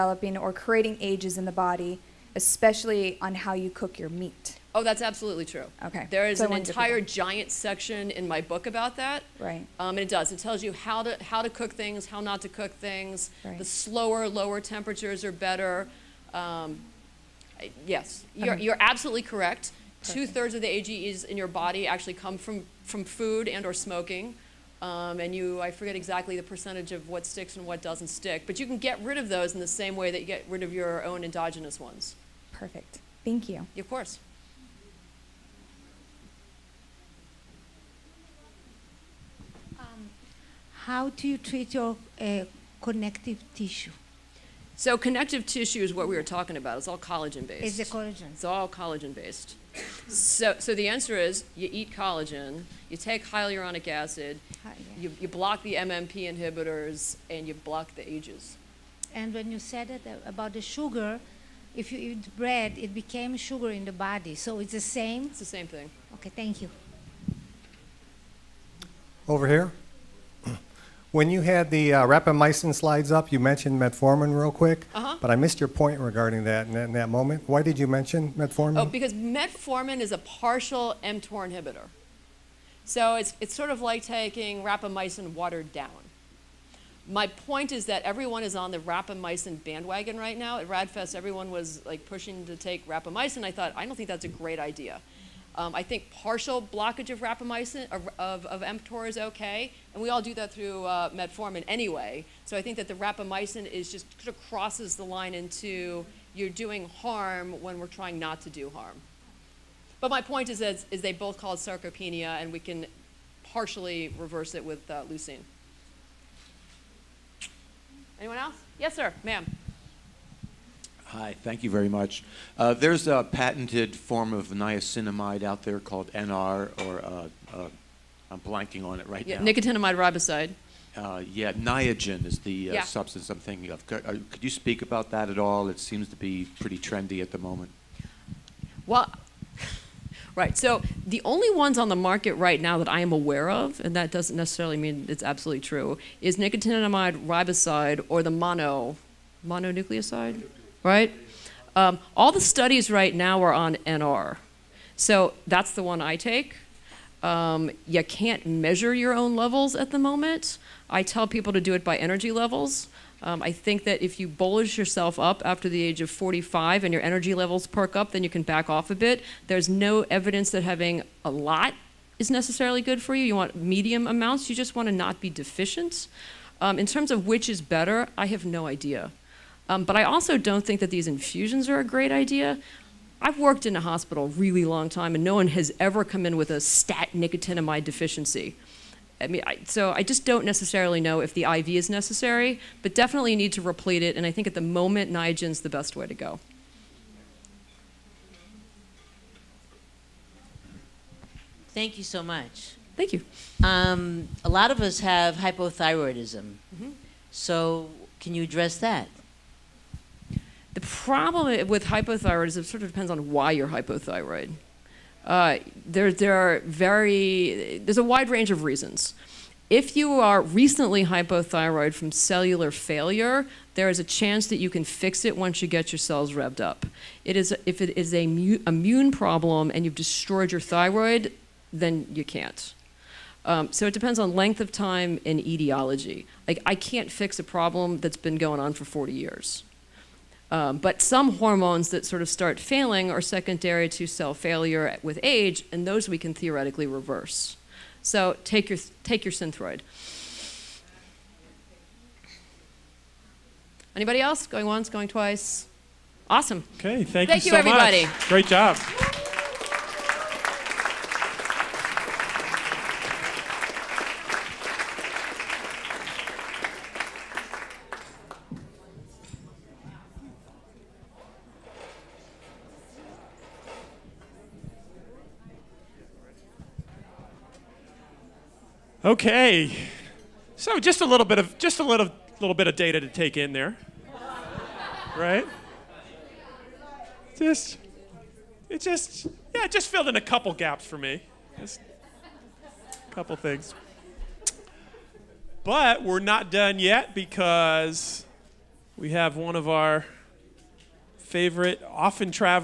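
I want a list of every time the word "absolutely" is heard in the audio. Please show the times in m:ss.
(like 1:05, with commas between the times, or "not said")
0:05, 0:18, 2:25.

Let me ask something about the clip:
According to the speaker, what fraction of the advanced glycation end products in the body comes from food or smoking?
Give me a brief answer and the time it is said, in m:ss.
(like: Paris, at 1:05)
Two thirds, at 0:20.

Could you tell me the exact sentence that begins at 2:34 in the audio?
So that's the one I take.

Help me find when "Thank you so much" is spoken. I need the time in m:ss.
3:21.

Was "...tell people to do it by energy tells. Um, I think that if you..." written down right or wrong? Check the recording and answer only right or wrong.
wrong.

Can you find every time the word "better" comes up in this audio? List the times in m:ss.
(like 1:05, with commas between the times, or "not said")
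0:15, 2:57.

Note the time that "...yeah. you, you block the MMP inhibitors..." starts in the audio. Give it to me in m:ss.
0:54.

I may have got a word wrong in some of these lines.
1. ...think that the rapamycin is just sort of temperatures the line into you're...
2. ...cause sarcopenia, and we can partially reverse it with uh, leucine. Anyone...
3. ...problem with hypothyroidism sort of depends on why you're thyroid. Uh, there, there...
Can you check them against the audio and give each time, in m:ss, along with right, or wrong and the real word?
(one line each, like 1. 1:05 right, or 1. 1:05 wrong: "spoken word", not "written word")
1. 1:42 wrong: "crosses", not "temperatures"
2. 1:51 right
3. 3:30 wrong: "hypothyroid", not "thyroid".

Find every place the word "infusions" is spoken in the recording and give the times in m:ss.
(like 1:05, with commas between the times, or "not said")
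3:01.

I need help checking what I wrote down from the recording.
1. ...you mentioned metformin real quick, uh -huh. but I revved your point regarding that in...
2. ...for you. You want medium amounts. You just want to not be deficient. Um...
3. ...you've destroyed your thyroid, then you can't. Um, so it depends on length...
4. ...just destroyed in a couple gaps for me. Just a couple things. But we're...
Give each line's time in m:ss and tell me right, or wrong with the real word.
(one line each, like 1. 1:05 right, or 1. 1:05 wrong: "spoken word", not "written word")
1. 1:13 wrong: "missed", not "revved"
2. 2:53 right
3. 3:49 right
4. 4:49 wrong: "filled", not "destroyed".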